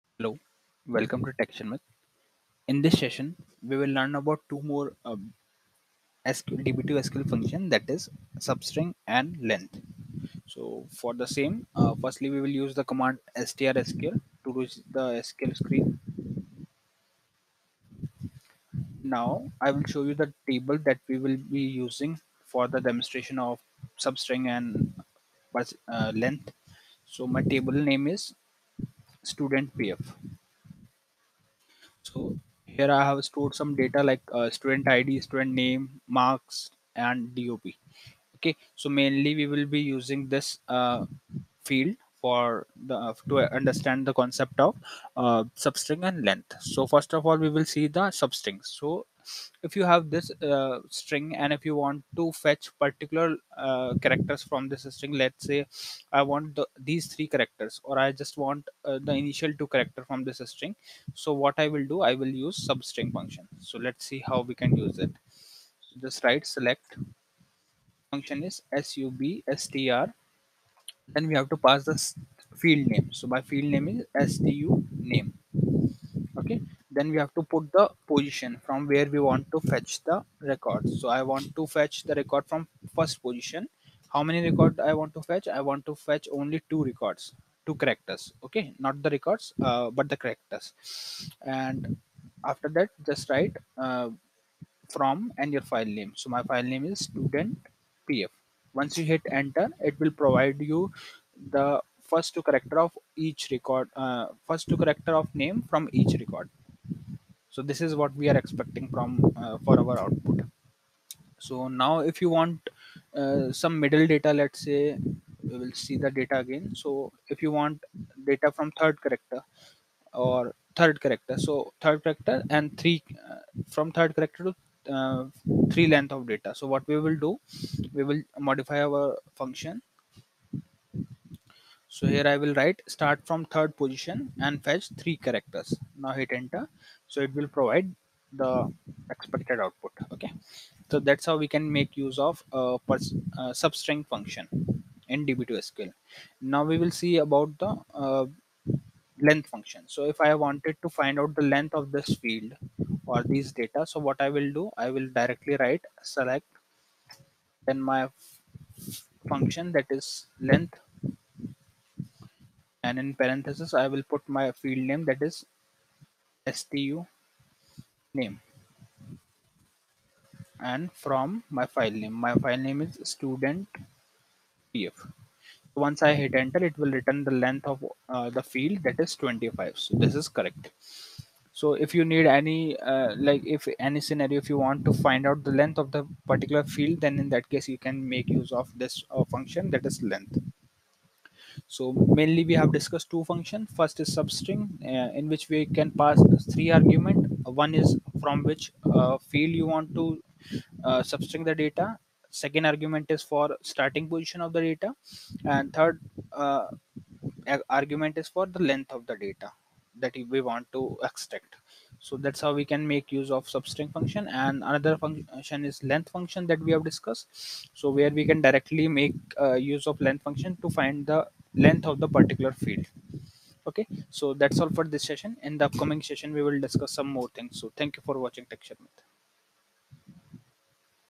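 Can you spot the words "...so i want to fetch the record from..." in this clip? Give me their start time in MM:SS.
01:20.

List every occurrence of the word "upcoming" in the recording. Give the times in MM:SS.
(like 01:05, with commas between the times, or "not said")
03:45.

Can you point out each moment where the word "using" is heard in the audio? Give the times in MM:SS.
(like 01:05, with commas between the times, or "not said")
00:21, 00:39.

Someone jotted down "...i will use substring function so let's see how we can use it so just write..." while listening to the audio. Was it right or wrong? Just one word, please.
right.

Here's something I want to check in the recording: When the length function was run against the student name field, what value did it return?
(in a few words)
25.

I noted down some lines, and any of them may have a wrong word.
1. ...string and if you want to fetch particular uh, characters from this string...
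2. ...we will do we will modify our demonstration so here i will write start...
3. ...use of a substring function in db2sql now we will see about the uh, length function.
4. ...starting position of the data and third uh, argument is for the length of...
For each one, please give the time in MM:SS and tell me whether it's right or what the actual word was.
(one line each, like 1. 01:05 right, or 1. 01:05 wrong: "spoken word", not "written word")
1. 00:50 right
2. 02:06 wrong: "function", not "demonstration"
3. 02:21 right
4. 03:23 right.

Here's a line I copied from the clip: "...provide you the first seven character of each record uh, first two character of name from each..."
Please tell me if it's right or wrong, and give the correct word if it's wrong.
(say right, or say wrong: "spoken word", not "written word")
wrong: "two", not "seven".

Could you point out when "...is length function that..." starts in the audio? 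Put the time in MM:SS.
03:35.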